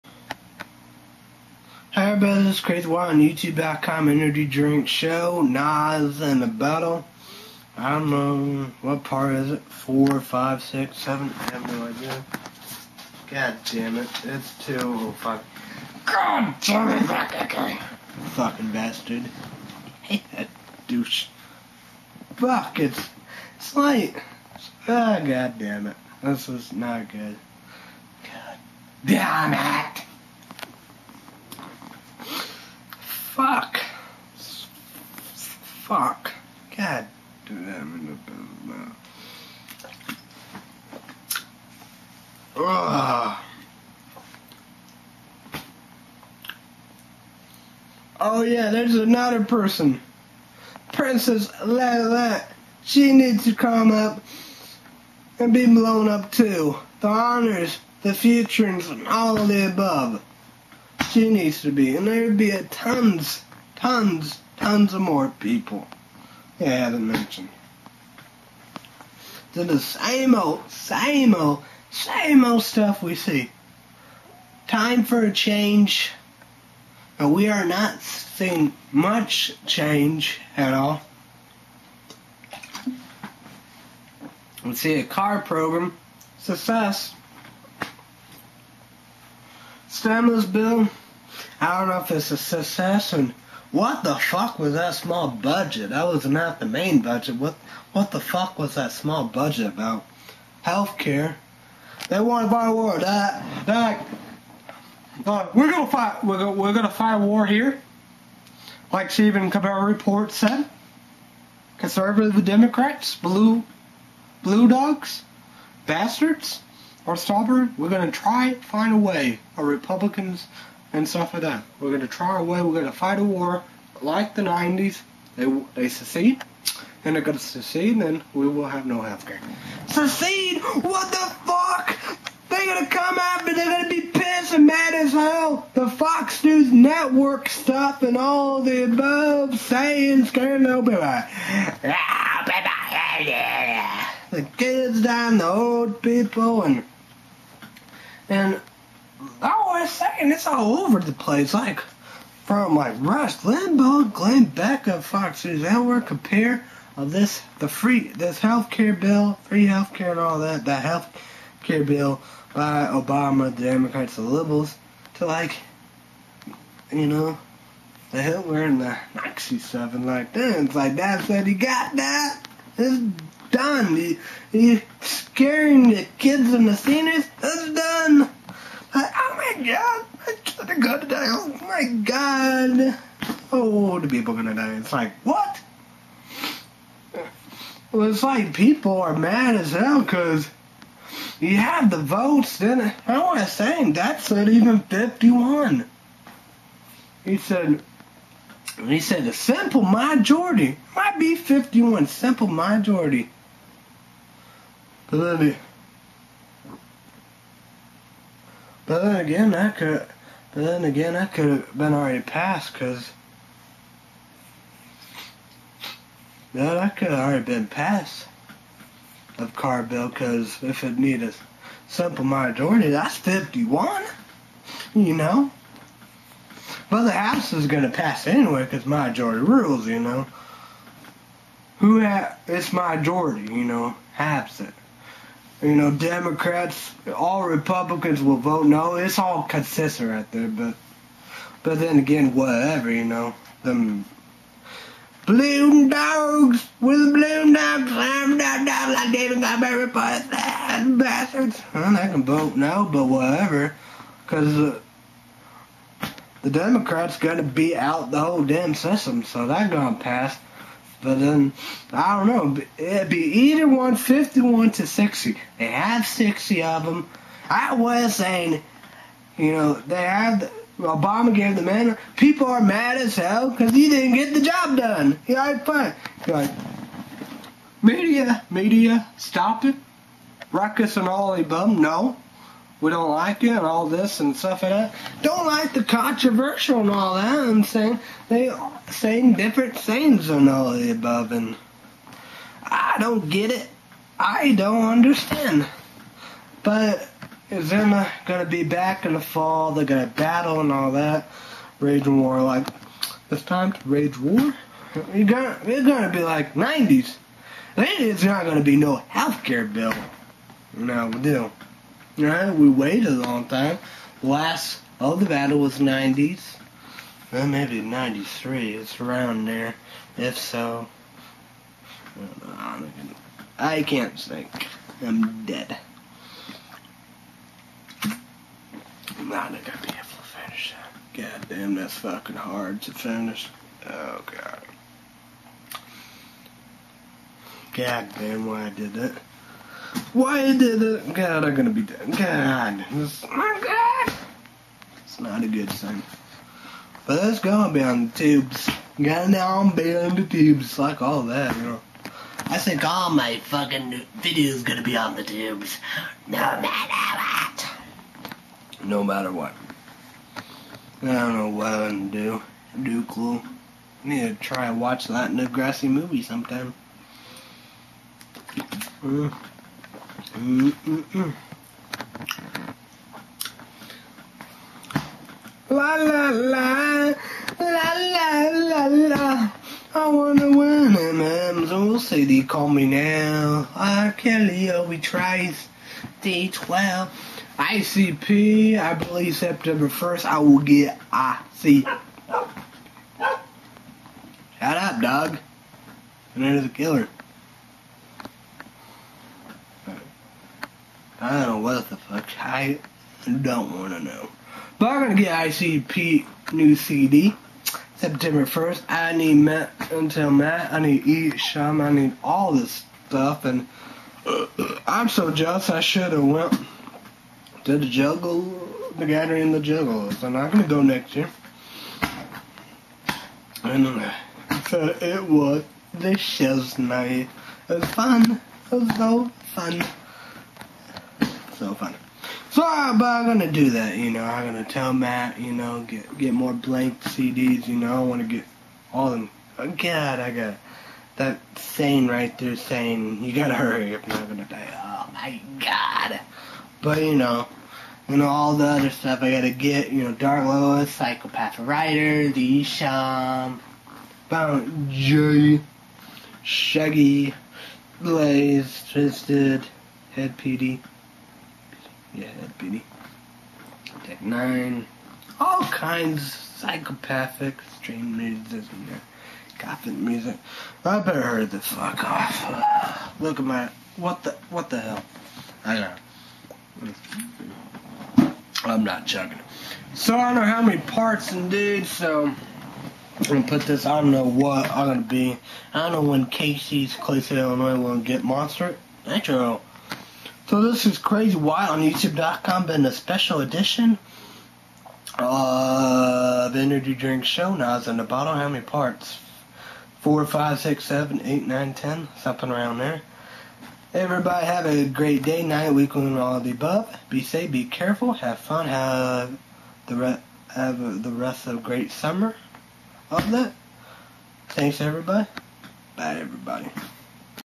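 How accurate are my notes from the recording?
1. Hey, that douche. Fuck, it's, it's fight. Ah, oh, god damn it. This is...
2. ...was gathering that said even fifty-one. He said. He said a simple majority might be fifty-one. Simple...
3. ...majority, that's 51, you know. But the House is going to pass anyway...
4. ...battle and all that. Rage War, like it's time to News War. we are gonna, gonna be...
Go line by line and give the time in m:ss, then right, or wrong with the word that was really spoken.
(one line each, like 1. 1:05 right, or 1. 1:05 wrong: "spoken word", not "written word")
1. 0:20 wrong: "light", not "fight"
2. 3:13 wrong: "saying", not "gathering"
3. 3:42 right
4. 5:00 wrong: "Rage", not "News".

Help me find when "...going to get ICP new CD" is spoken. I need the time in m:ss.
6:45.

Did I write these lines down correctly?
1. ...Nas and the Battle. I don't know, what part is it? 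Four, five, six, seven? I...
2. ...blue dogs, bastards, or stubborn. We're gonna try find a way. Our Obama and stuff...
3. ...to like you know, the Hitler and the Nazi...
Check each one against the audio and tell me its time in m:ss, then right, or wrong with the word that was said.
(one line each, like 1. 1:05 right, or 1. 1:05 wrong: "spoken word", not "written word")
1. 0:05 right
2. 1:54 wrong: "Republicans", not "Obama"
3. 2:45 right.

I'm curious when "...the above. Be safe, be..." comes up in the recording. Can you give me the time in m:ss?
8:26.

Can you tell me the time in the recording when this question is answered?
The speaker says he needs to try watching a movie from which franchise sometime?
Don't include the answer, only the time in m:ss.
6:05.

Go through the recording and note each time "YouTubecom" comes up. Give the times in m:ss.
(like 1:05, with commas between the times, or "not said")
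0:03, 8:11.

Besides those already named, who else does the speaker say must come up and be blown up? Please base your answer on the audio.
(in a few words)
Princess Lala.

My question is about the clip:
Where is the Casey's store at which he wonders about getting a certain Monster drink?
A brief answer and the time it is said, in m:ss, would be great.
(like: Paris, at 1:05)
Clay City, Illinois, at 8:06.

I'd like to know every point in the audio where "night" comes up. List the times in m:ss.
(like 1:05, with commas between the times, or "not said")
7:06, 8:25.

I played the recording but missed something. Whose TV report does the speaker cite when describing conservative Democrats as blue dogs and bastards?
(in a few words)
Stephen Colbert.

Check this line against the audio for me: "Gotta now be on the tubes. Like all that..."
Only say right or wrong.
right.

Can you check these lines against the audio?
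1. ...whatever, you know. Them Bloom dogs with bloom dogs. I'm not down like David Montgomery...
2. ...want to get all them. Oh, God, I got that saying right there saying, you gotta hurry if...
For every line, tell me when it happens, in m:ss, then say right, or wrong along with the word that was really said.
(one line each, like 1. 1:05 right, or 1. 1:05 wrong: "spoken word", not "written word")
1. 4:02 right
2. 7:18 right.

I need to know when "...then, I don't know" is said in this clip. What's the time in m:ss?
4:21.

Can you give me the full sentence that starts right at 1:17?
And we are not seeing much change at all.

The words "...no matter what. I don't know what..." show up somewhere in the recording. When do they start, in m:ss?
5:58.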